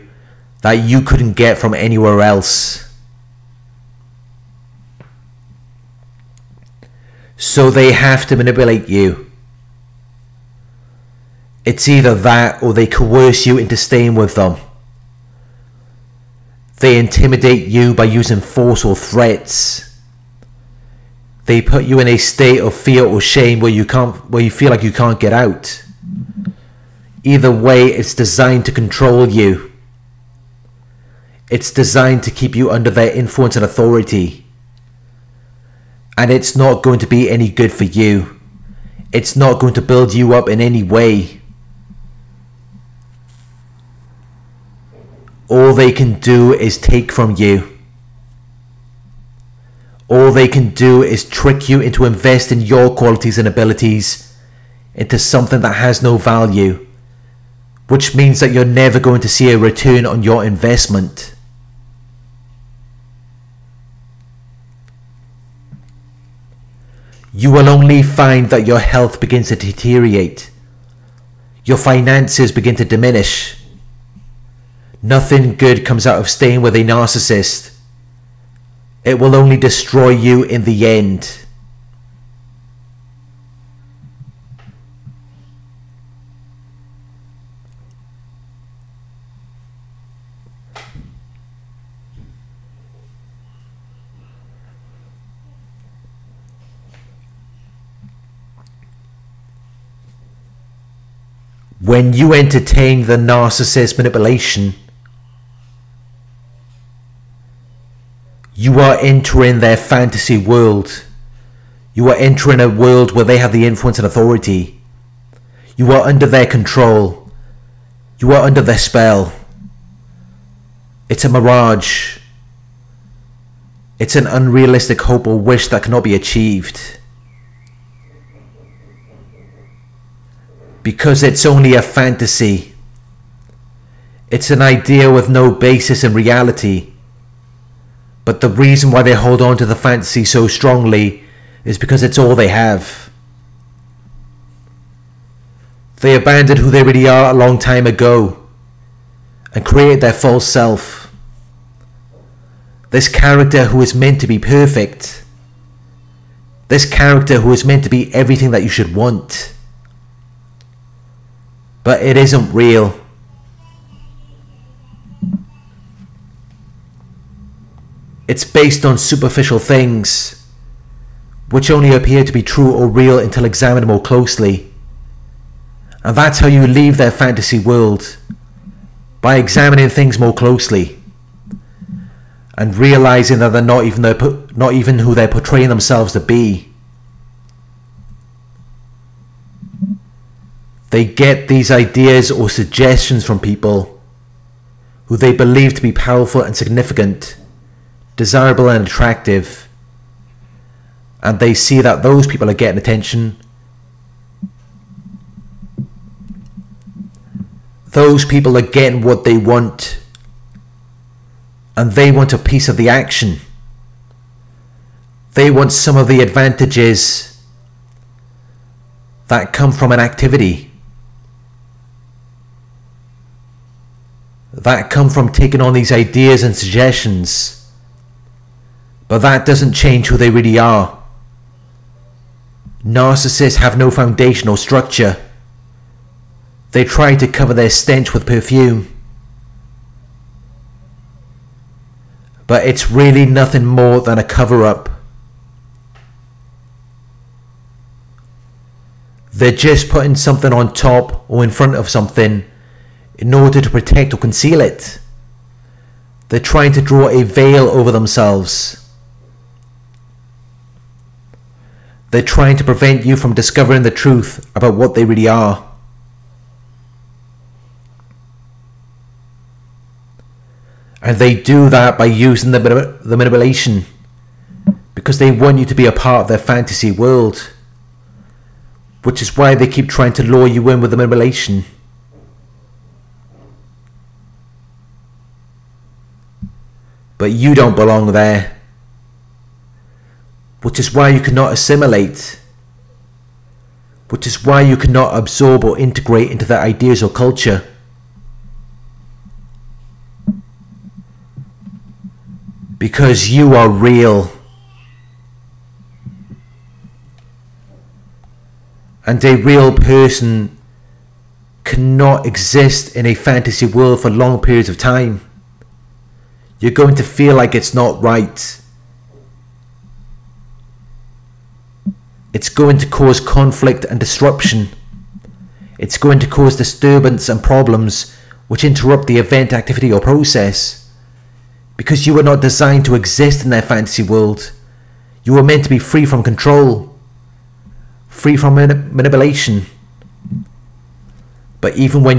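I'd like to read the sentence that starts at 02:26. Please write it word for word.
They abandoned who they really are a long time ago and created their false self.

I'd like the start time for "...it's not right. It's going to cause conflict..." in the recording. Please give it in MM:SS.
05:17.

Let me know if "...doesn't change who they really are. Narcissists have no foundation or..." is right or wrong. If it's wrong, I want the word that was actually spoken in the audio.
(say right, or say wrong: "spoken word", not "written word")
right.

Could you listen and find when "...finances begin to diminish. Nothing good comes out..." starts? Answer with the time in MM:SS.
01:11.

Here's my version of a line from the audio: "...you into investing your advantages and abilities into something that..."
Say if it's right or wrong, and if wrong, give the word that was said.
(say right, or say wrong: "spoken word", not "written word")
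wrong: "qualities", not "advantages".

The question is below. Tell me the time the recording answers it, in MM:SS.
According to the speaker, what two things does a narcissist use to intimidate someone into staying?
00:18.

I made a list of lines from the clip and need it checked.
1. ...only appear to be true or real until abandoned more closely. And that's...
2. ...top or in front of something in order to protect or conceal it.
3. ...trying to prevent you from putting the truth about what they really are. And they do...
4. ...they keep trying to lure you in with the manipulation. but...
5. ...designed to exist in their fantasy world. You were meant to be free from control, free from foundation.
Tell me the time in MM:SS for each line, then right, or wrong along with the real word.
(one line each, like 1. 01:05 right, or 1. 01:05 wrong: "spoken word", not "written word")
1. 02:51 wrong: "examined", not "abandoned"
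2. 04:10 right
3. 04:22 wrong: "discovering", not "putting"
4. 04:39 right
5. 05:32 wrong: "manipulation", not "foundation".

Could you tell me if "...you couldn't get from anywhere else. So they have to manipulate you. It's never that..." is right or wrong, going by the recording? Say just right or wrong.
wrong.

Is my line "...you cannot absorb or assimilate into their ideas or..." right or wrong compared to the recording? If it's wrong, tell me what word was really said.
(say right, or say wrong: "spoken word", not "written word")
wrong: "integrate", not "assimilate".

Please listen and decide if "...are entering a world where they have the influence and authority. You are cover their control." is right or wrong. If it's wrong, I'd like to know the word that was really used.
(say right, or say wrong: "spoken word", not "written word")
wrong: "under", not "cover".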